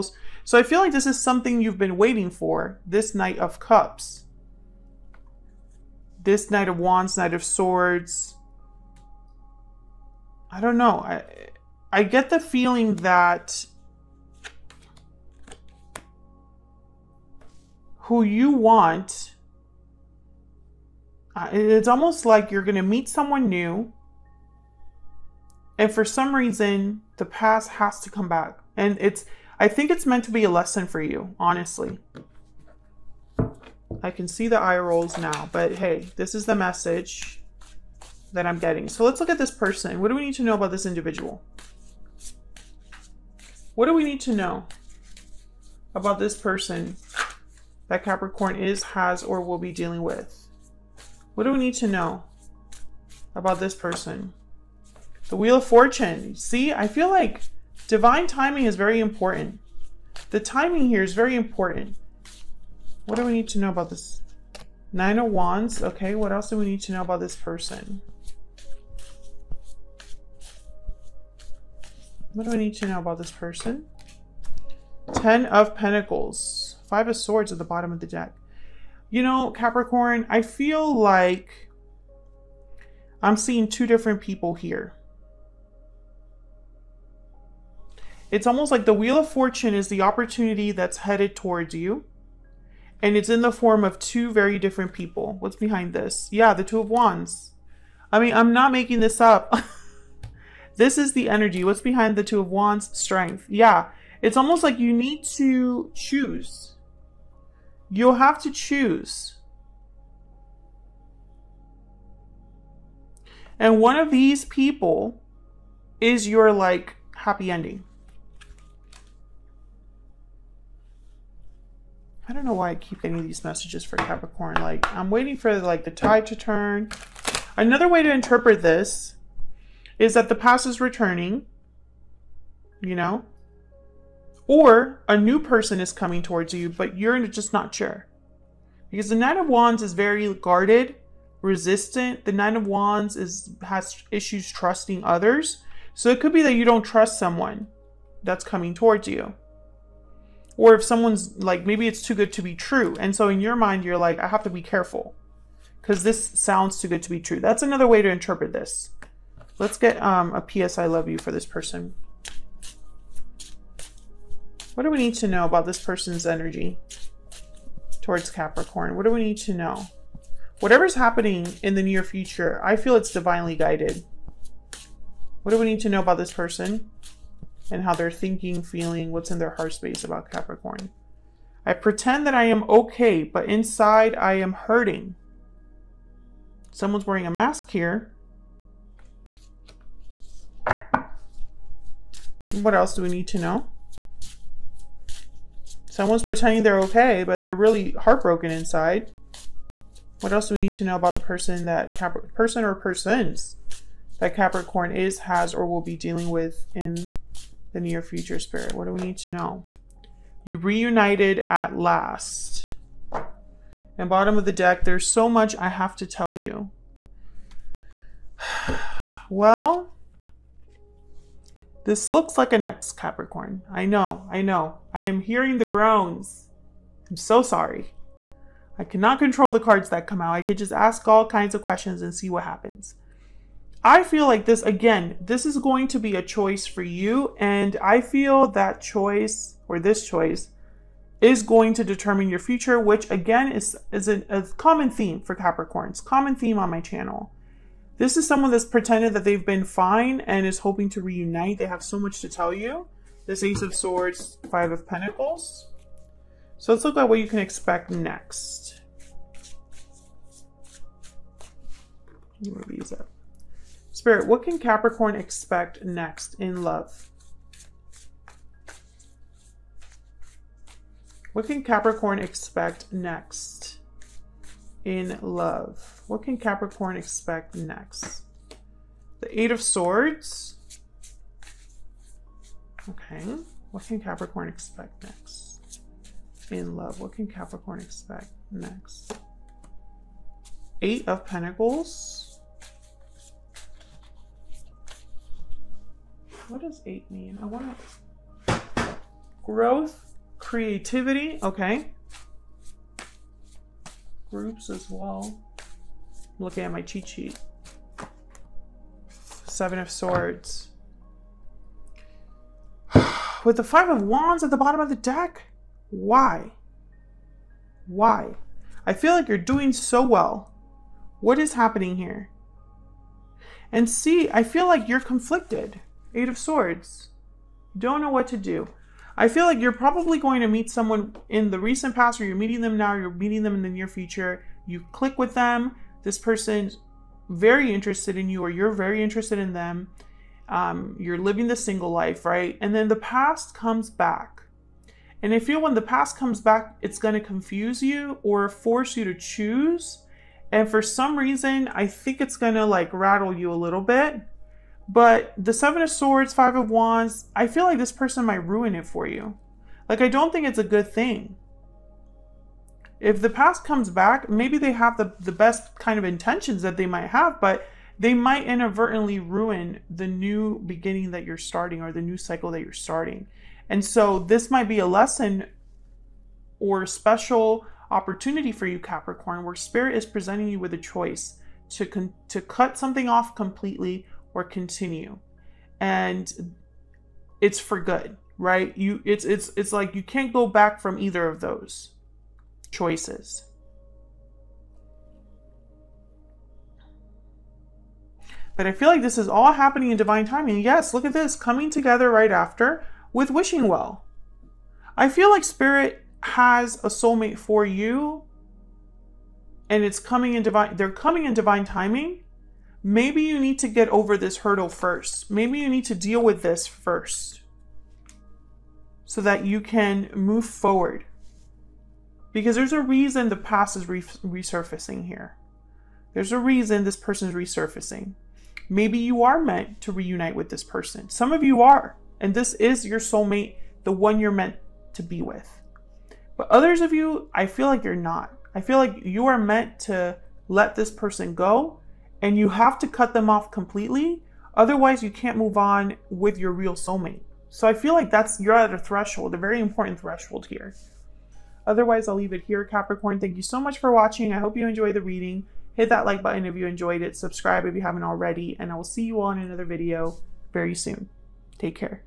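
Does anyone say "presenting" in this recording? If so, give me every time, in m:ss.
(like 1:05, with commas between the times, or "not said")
6:20.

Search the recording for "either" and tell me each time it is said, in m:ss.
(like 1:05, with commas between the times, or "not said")
6:30.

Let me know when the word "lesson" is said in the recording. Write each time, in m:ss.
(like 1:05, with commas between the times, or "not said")
0:30, 6:14.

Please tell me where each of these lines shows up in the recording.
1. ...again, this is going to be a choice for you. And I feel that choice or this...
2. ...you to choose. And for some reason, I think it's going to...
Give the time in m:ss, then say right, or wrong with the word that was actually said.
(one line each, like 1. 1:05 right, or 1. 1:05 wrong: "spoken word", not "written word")
1. 3:54 right
2. 5:48 right.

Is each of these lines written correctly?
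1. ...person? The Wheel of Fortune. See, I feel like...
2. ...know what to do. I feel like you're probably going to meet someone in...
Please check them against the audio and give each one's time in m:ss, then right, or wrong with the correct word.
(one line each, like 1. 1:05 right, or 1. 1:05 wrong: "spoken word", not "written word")
1. 0:53 right
2. 5:27 right.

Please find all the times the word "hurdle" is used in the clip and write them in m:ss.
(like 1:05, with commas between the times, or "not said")
6:54.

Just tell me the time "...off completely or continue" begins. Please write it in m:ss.
6:23.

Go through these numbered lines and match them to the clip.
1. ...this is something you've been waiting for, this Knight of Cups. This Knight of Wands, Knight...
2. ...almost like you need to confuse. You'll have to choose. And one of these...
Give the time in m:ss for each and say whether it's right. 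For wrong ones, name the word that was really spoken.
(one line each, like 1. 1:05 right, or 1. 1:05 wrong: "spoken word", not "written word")
1. 0:00 right
2. 1:44 wrong: "choose", not "confuse".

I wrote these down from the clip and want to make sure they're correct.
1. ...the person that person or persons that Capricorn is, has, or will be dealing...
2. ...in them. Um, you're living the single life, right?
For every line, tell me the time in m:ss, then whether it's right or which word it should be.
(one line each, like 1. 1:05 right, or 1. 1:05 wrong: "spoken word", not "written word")
1. 3:21 right
2. 5:39 right.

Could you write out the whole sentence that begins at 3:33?
And bottom of the deck, there's so much I have to tell you.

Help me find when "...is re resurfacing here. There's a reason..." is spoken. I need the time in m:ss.
7:03.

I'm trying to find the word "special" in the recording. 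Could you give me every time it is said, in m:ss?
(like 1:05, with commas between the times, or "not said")
6:16.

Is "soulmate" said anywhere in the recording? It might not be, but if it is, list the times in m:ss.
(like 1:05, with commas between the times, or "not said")
6:46, 7:12, 7:26.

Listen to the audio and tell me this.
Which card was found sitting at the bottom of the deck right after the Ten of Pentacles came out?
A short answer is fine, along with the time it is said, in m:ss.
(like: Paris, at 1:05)
Five of Swords, at 1:16.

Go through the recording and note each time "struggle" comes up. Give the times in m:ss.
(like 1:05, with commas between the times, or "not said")
not said.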